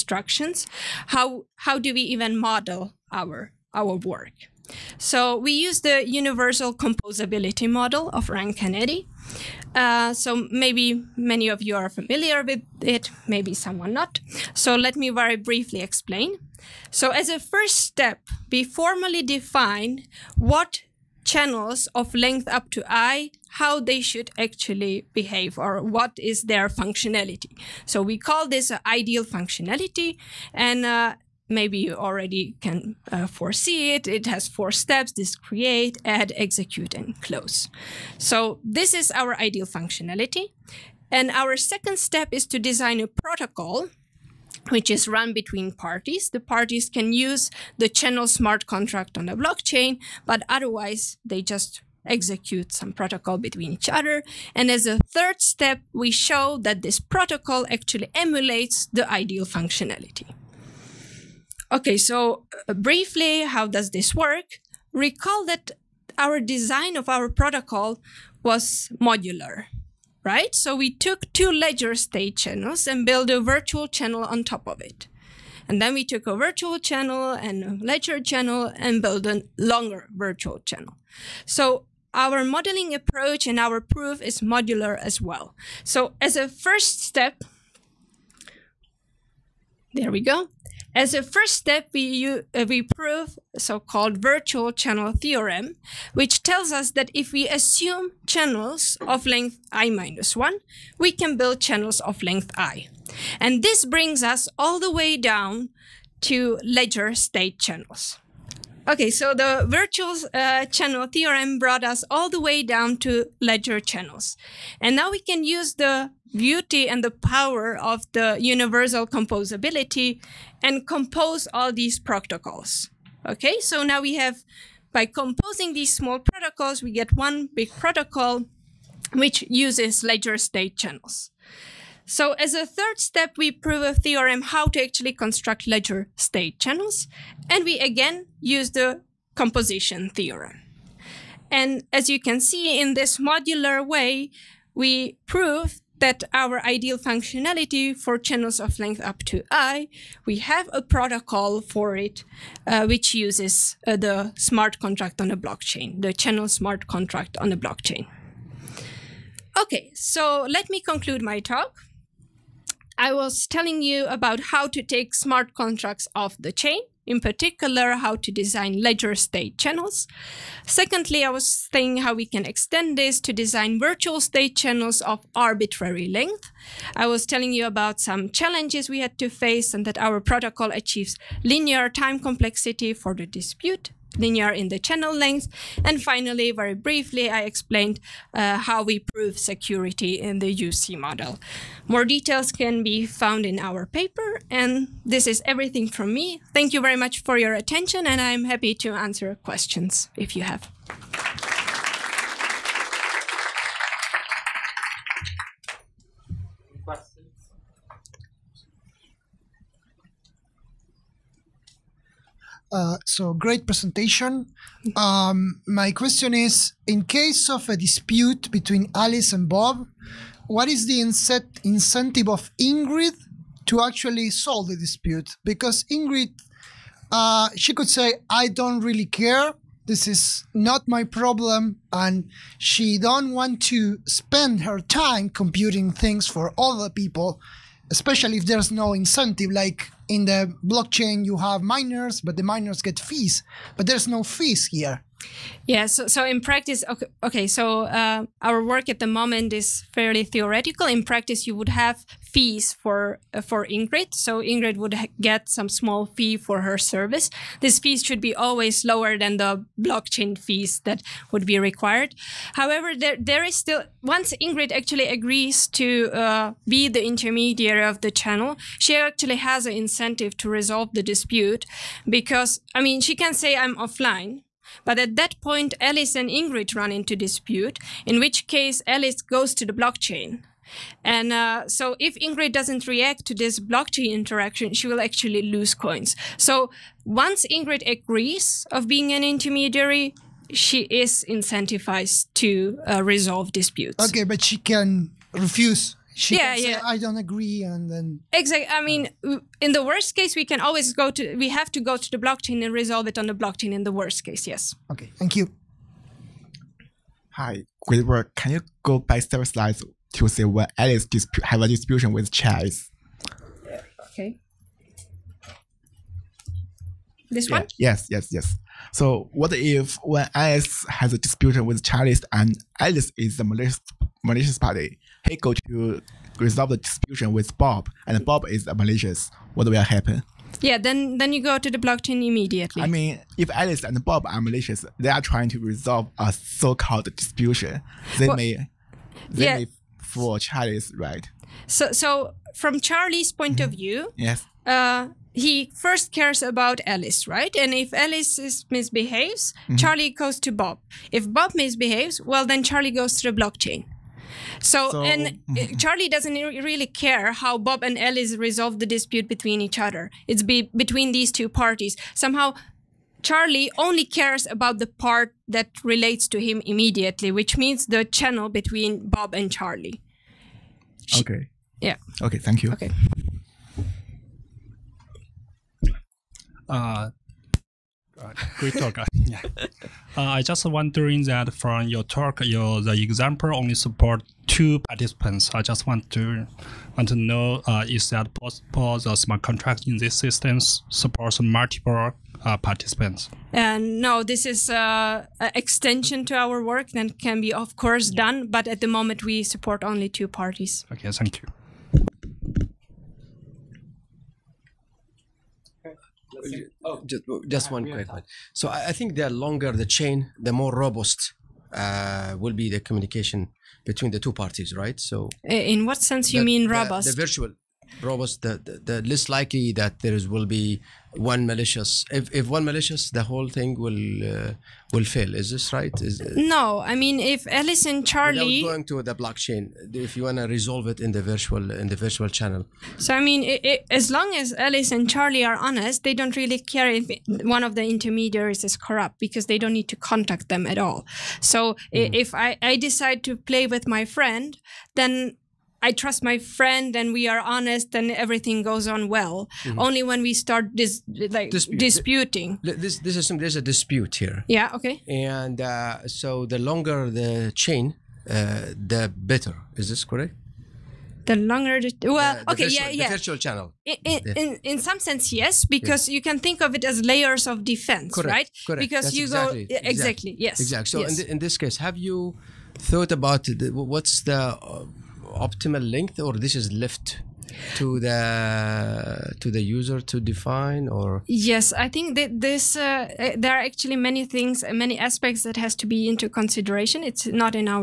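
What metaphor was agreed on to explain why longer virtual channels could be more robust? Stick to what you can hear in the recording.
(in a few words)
layers of defense.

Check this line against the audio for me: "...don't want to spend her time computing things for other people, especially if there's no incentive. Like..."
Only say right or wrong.
right.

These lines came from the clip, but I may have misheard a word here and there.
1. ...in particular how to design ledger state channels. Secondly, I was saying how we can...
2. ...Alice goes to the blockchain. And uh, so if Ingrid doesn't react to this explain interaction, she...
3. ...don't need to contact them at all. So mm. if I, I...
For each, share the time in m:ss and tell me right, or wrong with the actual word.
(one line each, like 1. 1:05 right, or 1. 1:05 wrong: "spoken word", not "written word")
1. 2:47 right
2. 4:38 wrong: "blockchain", not "explain"
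3. 7:19 right.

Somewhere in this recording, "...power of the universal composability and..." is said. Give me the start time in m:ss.
1:57.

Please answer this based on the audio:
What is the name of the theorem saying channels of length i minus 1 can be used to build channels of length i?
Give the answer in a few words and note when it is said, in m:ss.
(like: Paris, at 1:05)
virtual channel theorem, at 1:34.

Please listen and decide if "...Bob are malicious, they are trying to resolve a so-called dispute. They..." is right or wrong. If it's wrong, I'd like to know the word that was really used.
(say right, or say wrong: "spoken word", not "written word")
right.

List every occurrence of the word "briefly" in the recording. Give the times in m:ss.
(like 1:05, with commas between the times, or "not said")
0:15, 1:02, 3:06.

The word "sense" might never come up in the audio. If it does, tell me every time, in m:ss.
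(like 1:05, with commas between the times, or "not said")
6:55, 7:44.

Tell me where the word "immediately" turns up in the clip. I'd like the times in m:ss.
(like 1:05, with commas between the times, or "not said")
5:32, 6:06.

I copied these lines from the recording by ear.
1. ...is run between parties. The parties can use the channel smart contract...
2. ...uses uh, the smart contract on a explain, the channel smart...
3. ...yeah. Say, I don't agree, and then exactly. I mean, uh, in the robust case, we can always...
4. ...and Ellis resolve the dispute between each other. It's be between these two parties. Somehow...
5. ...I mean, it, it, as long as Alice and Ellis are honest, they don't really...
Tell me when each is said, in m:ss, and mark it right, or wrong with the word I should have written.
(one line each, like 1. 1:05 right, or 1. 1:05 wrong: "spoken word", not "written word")
1. 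0:44 right
2. 2:33 wrong: "blockchain", not "explain"
3. 4:56 wrong: "worst", not "robust"
4. 5:57 right
5. 7:13 wrong: "Charlie", not "Ellis".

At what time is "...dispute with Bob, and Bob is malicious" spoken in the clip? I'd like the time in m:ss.
5:26.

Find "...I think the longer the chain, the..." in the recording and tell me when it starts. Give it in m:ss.
6:48.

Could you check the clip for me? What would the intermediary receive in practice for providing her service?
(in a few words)
small fee.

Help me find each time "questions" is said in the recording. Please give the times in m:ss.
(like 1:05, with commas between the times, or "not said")
3:19, 3:35.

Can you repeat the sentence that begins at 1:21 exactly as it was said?
So our modeling approach and our proof is modular as well.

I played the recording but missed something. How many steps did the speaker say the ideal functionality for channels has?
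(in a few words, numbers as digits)
4.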